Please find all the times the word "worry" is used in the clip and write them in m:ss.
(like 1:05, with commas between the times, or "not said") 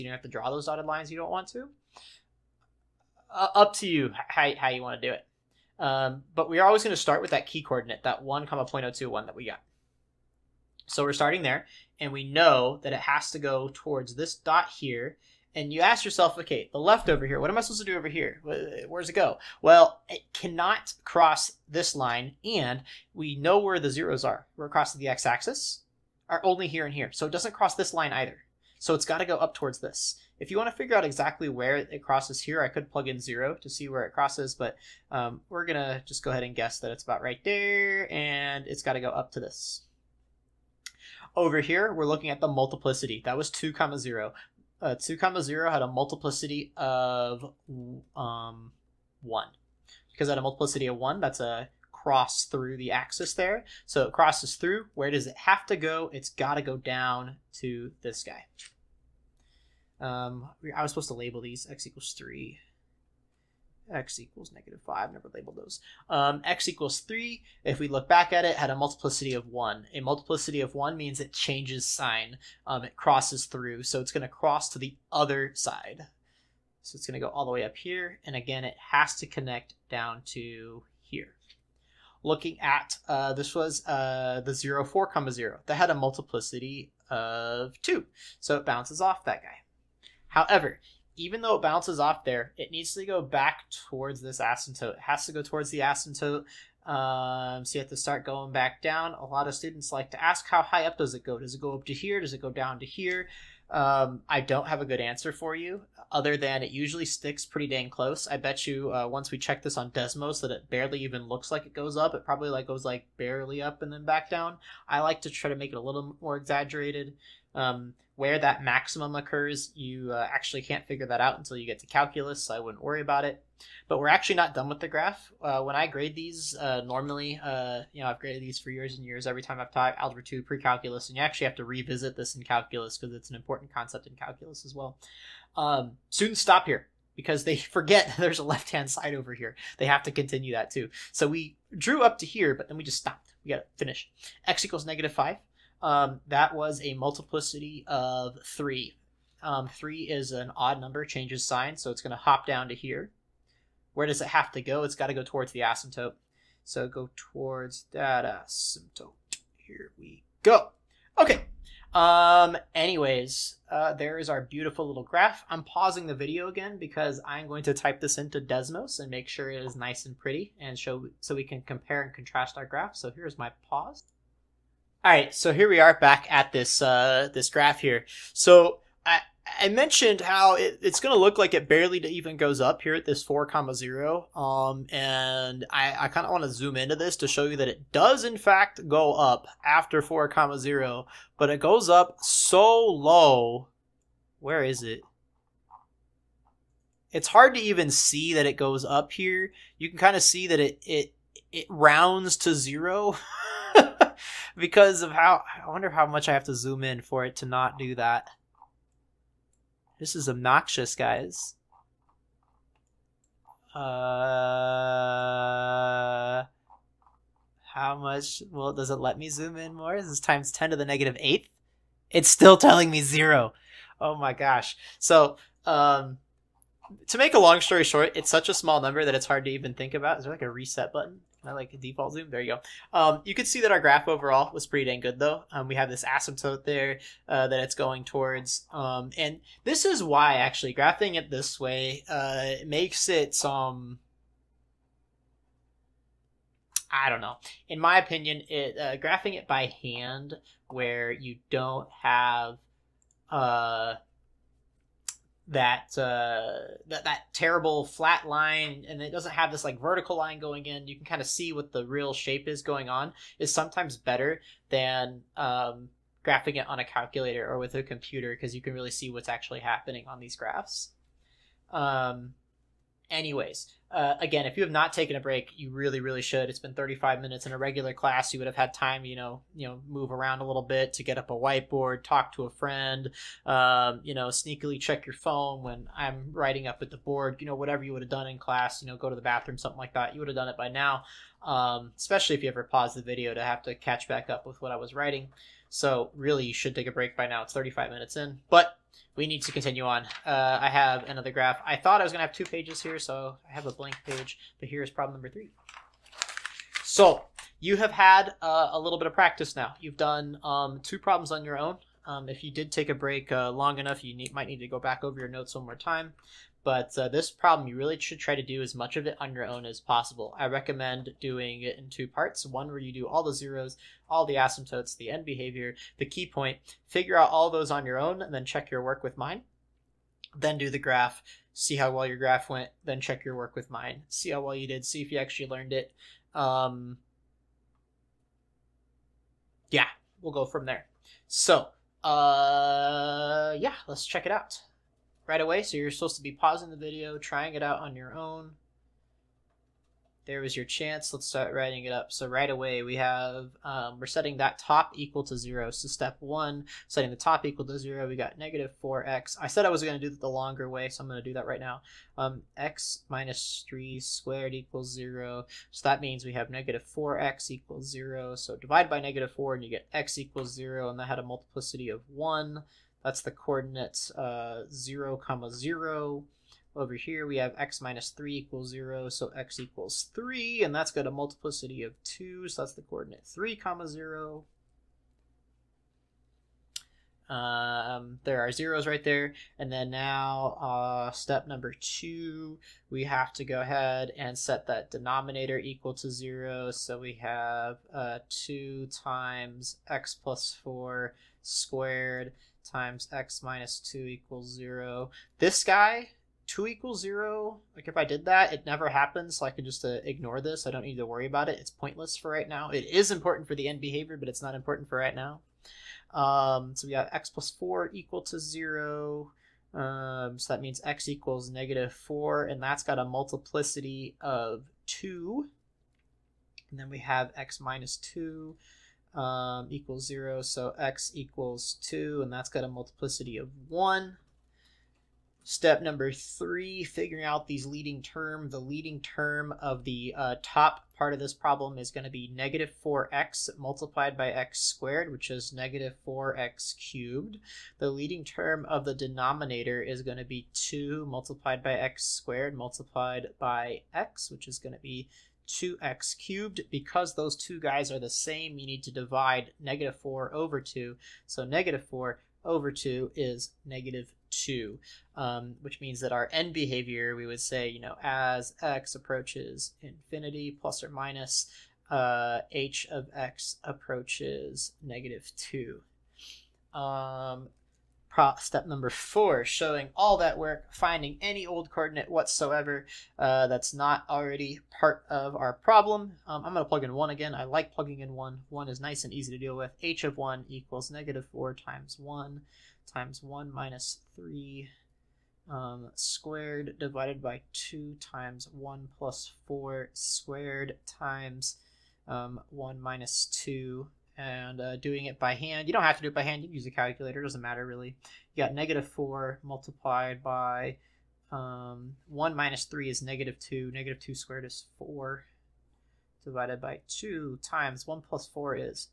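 2:02, 6:51.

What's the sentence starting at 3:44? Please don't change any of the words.
So, um, to make a long story short, it's such a small number that it's hard to even think about.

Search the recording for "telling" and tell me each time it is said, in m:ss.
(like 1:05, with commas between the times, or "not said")
3:42.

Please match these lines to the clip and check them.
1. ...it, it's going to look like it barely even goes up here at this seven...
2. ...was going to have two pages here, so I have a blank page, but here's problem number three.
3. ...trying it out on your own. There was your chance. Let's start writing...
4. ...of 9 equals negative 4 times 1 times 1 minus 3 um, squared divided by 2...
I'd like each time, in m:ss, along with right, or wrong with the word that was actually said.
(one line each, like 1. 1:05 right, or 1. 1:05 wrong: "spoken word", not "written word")
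1. 3:00 wrong: "four", not "seven"
2. 5:02 right
3. 5:47 right
4. 8:10 wrong: "1", not "9".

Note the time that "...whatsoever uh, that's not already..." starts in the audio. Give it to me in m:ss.
8:02.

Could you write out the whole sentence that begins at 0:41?
Over here, we're looking at the multiplicity.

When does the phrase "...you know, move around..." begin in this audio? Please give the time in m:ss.
4:39.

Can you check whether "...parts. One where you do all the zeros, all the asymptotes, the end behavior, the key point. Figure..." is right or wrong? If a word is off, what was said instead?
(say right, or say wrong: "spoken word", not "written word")
right.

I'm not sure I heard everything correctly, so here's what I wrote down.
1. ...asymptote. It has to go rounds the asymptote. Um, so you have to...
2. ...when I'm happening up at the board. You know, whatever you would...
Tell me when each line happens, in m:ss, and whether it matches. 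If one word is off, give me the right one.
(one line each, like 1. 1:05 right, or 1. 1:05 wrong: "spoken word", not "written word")
1. 1:34 wrong: "towards", not "rounds"
2. 4:45 wrong: "writing", not "happening".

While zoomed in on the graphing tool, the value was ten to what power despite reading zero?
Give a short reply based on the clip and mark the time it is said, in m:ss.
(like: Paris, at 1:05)
negative eighth, at 3:40.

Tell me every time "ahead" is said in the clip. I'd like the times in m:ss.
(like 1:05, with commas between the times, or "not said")
0:36, 6:33.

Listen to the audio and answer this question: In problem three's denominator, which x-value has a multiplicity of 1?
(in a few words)
2.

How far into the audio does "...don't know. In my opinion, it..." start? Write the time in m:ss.
4:07.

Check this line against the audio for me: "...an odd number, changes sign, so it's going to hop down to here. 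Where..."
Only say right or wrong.
right.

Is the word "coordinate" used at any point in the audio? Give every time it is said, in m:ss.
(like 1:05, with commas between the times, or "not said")
0:07, 6:13, 6:22, 8:01.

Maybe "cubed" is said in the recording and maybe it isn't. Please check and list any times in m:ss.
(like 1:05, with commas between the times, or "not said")
7:26, 7:36.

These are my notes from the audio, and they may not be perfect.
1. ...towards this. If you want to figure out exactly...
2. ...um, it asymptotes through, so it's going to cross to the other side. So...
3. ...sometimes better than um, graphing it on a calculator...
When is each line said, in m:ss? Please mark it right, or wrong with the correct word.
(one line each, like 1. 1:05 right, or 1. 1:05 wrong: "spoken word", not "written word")
1. 0:29 right
2. 1:12 wrong: "crosses", not "asymptotes"
3. 4:23 right.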